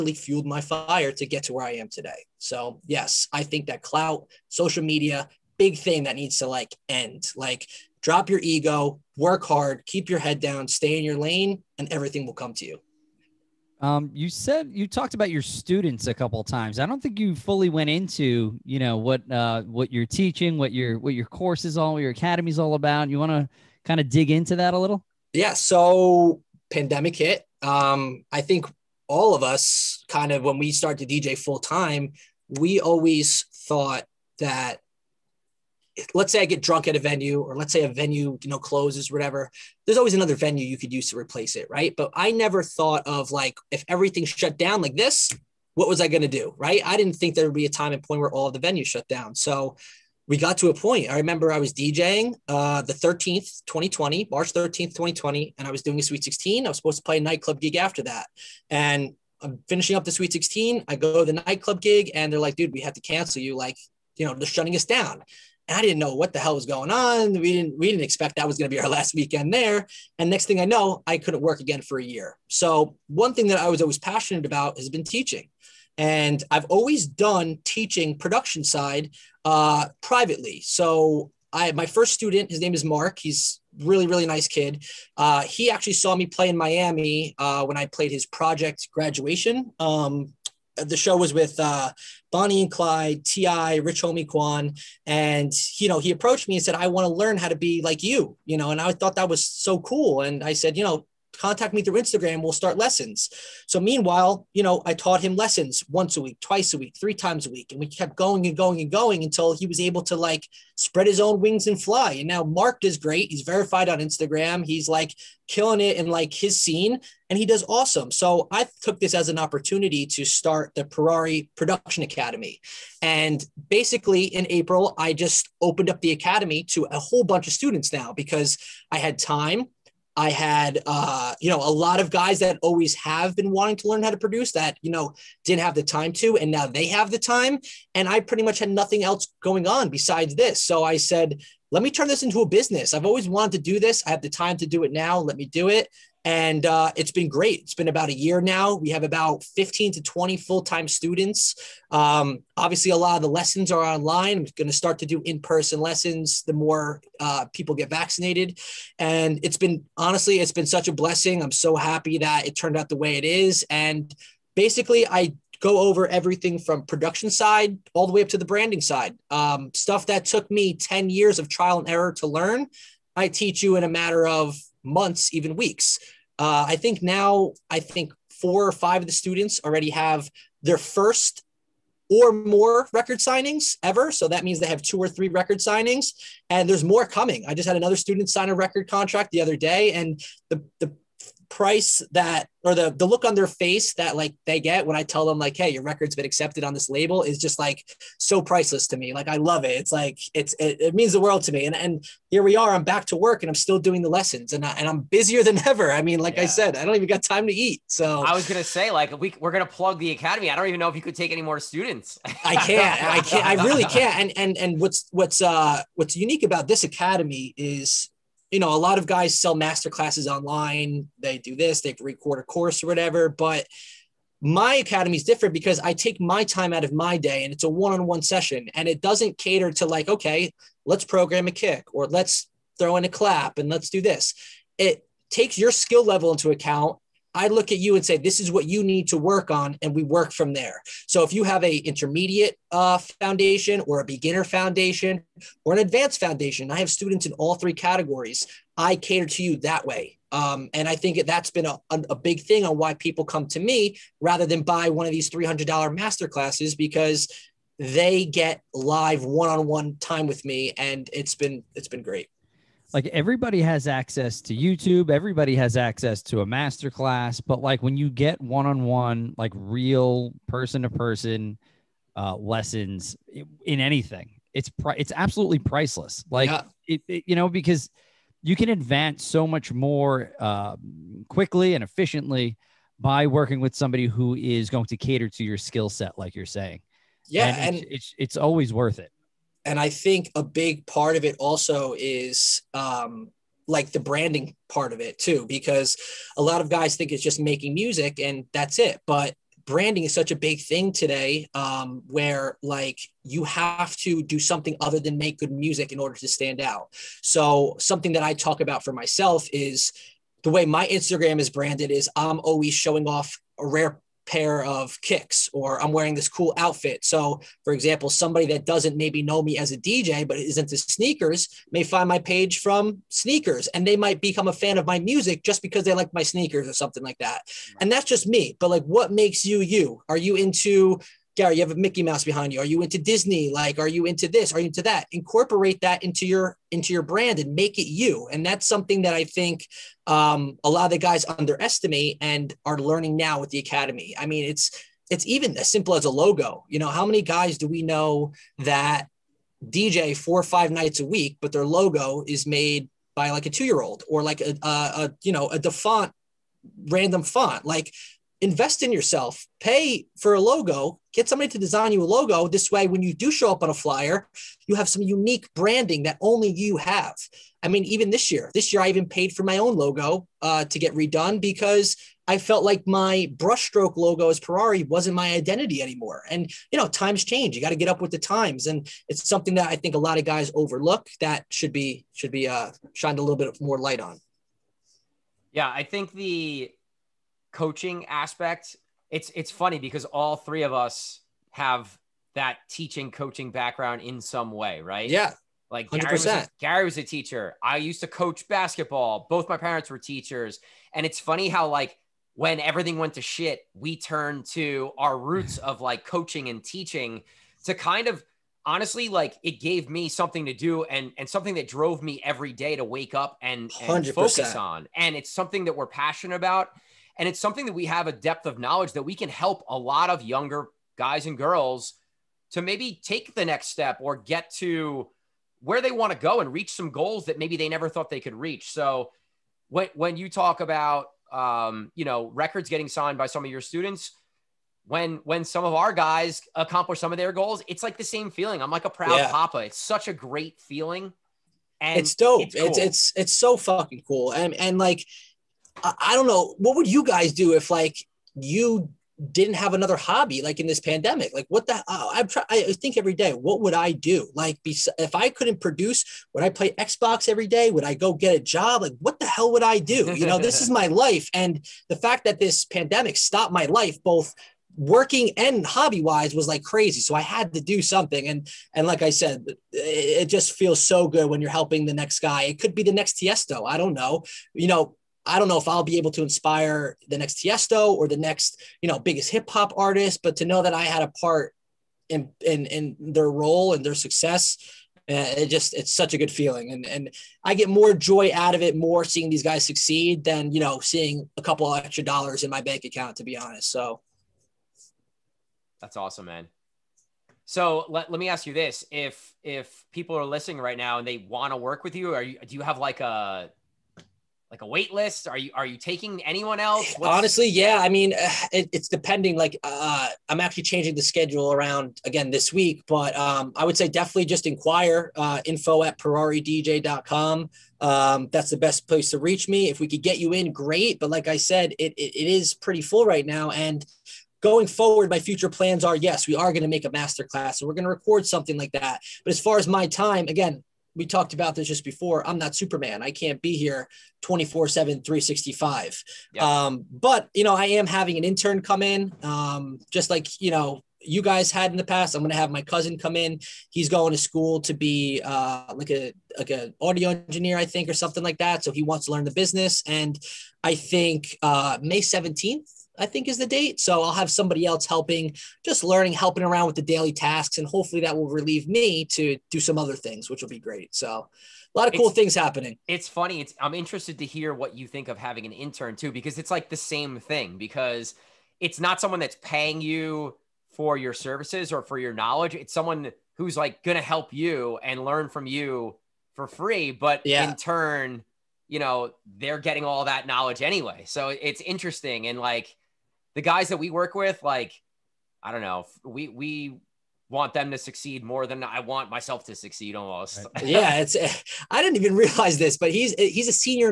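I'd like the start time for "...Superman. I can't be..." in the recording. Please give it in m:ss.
8:52.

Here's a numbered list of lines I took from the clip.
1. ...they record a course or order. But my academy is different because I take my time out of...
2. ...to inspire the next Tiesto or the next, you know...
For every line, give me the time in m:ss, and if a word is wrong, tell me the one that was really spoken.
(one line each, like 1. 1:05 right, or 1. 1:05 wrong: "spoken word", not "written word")
1. 3:41 wrong: "whatever", not "order"
2. 7:56 right.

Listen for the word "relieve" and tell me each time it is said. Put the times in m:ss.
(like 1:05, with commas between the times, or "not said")
9:18.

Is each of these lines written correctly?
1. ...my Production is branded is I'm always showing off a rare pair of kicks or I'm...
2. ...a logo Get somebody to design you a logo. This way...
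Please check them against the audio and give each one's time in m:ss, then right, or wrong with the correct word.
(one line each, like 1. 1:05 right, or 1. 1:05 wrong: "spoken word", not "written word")
1. 5:10 wrong: "Instagram", not "Production"
2. 6:00 right.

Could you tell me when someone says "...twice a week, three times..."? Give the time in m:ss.
1:46.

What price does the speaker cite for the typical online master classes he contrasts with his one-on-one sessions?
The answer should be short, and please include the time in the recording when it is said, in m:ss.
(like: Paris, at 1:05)
$300, at 4:15.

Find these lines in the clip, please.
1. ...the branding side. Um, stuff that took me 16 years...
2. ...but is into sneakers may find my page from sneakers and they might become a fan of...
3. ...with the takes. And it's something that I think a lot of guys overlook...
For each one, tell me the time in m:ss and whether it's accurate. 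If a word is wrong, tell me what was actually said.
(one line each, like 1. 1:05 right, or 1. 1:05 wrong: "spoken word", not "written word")
1. 2:48 wrong: "10", not "16"
2. 5:20 right
3. 6:18 wrong: "times", not "takes".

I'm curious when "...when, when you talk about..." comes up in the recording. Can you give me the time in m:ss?
7:09.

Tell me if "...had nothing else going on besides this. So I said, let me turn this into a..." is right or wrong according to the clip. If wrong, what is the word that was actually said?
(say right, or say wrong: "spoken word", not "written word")
right.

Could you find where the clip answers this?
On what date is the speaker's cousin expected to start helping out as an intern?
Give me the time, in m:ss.
9:11.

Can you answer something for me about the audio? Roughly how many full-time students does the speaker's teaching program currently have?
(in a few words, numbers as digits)
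15 to 20.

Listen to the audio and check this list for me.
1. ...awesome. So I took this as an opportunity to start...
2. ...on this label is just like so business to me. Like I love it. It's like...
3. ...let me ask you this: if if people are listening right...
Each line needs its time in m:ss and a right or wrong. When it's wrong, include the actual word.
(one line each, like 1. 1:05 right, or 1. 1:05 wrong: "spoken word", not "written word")
1. 1:57 right
2. 3:16 wrong: "priceless", not "business"
3. 8:18 right.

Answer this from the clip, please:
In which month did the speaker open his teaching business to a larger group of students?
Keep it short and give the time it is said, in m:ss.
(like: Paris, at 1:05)
April, at 2:04.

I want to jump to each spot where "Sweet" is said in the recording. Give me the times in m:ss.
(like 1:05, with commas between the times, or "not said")
0:56, 1:00.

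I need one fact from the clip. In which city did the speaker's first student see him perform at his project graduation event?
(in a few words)
Miami.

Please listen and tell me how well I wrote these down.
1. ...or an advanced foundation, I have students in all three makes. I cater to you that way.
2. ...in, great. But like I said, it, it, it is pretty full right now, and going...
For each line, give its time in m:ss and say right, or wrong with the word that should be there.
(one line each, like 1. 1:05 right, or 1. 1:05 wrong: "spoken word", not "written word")
1. 4:05 wrong: "categories", not "makes"
2. 8:40 right.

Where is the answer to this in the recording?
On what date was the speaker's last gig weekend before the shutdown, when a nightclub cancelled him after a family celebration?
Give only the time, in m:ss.
0:54.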